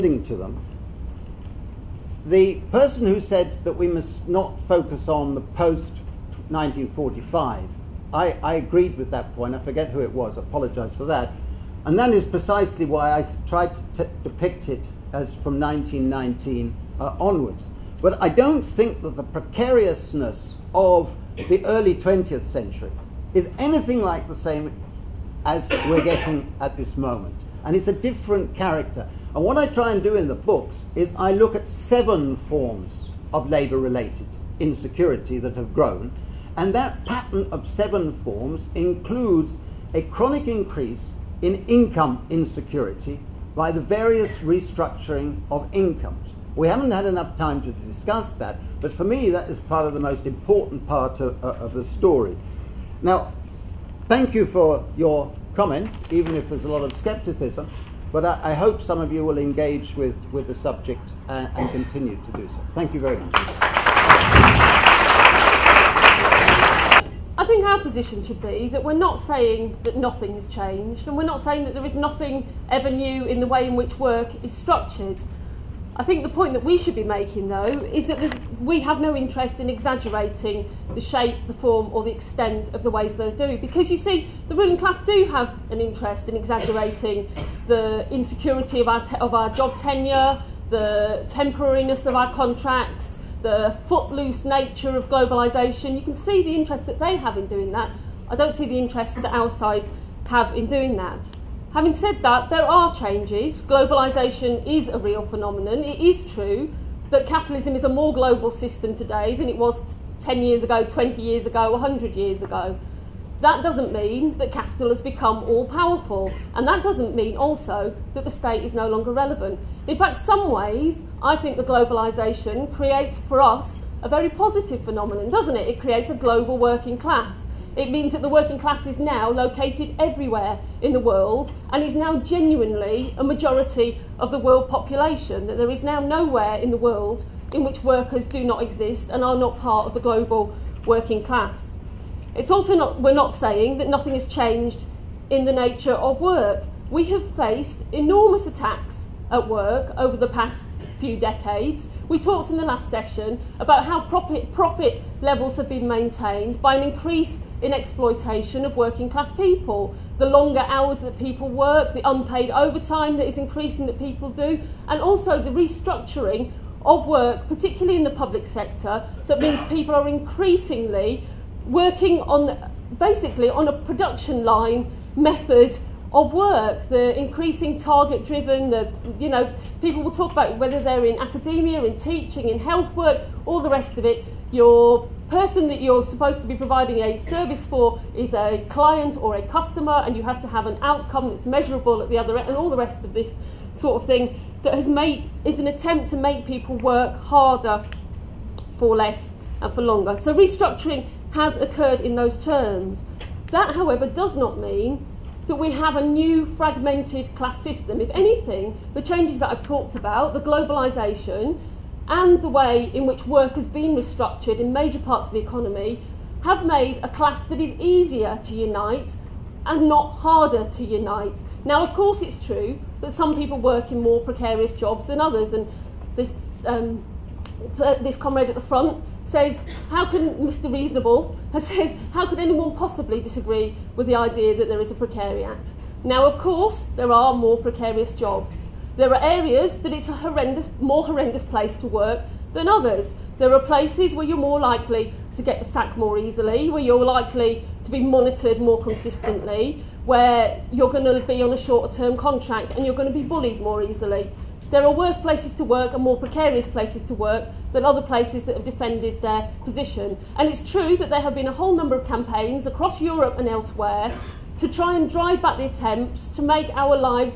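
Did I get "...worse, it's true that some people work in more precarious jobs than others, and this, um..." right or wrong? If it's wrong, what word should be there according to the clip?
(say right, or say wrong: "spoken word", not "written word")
wrong: "course", not "worse".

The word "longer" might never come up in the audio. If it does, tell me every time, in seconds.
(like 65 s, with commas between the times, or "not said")
118 s, 160 s, 199 s.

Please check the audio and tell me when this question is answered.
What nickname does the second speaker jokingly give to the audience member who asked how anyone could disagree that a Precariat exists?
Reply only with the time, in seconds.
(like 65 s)
230 s.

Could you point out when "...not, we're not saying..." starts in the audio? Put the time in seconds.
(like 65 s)
142 s.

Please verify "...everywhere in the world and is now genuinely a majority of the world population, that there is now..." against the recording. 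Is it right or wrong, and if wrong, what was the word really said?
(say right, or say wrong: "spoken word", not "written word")
right.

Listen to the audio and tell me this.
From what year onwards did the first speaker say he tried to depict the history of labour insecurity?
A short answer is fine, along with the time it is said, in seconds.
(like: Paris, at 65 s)
1919, at 15 s.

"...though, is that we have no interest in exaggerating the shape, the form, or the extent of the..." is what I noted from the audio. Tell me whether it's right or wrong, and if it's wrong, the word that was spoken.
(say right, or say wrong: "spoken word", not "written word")
right.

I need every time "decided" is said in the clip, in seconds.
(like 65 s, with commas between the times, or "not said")
not said.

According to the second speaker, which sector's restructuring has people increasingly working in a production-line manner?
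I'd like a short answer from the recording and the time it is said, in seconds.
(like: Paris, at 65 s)
public sector, at 168 s.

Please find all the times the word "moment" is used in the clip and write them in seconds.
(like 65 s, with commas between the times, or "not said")
26 s.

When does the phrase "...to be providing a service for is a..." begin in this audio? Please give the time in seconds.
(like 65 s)
186 s.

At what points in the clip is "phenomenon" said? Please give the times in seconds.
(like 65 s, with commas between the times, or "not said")
105 s, 124 s.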